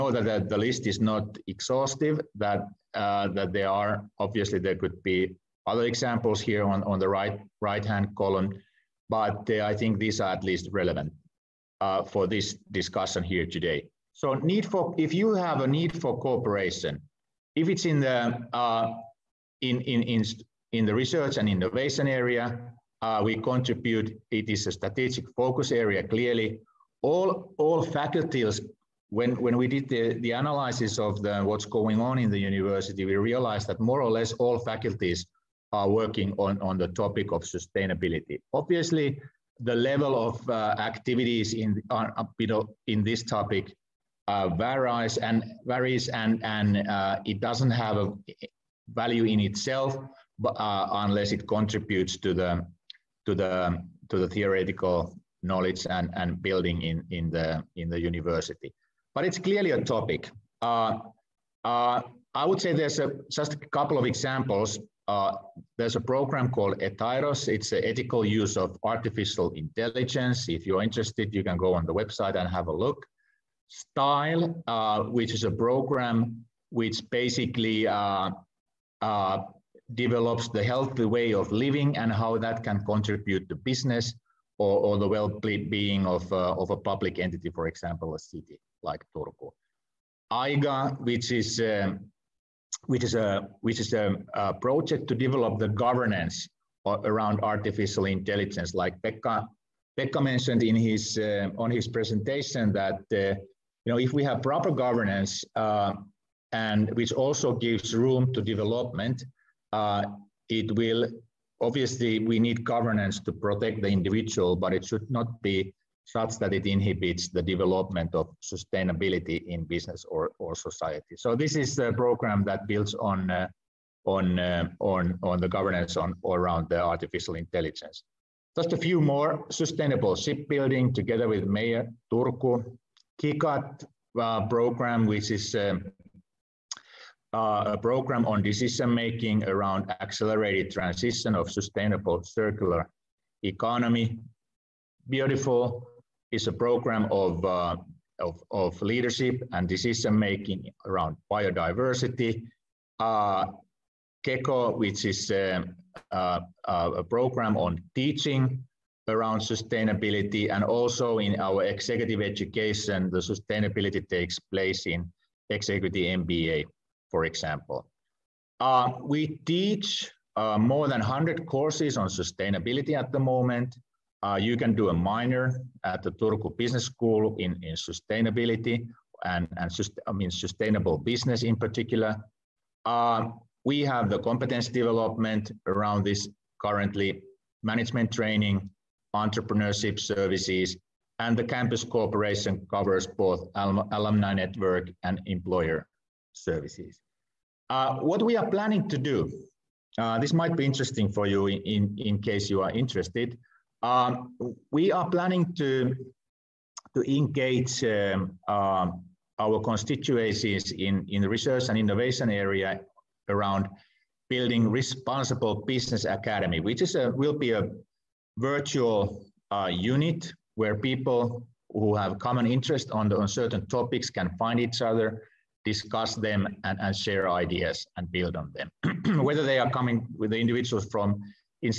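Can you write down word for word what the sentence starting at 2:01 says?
So this is a program that builds on uh, on uh, on on the governance on around the artificial intelligence.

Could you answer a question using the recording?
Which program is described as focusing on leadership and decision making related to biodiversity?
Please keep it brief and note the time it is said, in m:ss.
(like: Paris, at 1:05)
BIODIFUL, at 2:25.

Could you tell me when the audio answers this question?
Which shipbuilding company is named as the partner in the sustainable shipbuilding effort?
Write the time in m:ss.
2:11.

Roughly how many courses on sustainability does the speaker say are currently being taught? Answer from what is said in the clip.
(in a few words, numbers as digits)
more than 100.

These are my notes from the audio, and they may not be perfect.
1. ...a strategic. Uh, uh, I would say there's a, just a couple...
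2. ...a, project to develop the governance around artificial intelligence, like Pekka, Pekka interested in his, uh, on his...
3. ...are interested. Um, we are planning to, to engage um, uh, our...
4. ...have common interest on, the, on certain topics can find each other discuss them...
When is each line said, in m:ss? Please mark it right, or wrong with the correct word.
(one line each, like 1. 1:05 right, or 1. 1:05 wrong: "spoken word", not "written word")
1. 0:59 wrong: "topic", not "strategic"
2. 1:34 wrong: "mentioned", not "interested"
3. 3:22 right
4. 3:41 right.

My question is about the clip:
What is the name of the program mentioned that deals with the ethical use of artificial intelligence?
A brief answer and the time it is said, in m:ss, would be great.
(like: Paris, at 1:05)
ETAIROS, at 1:06.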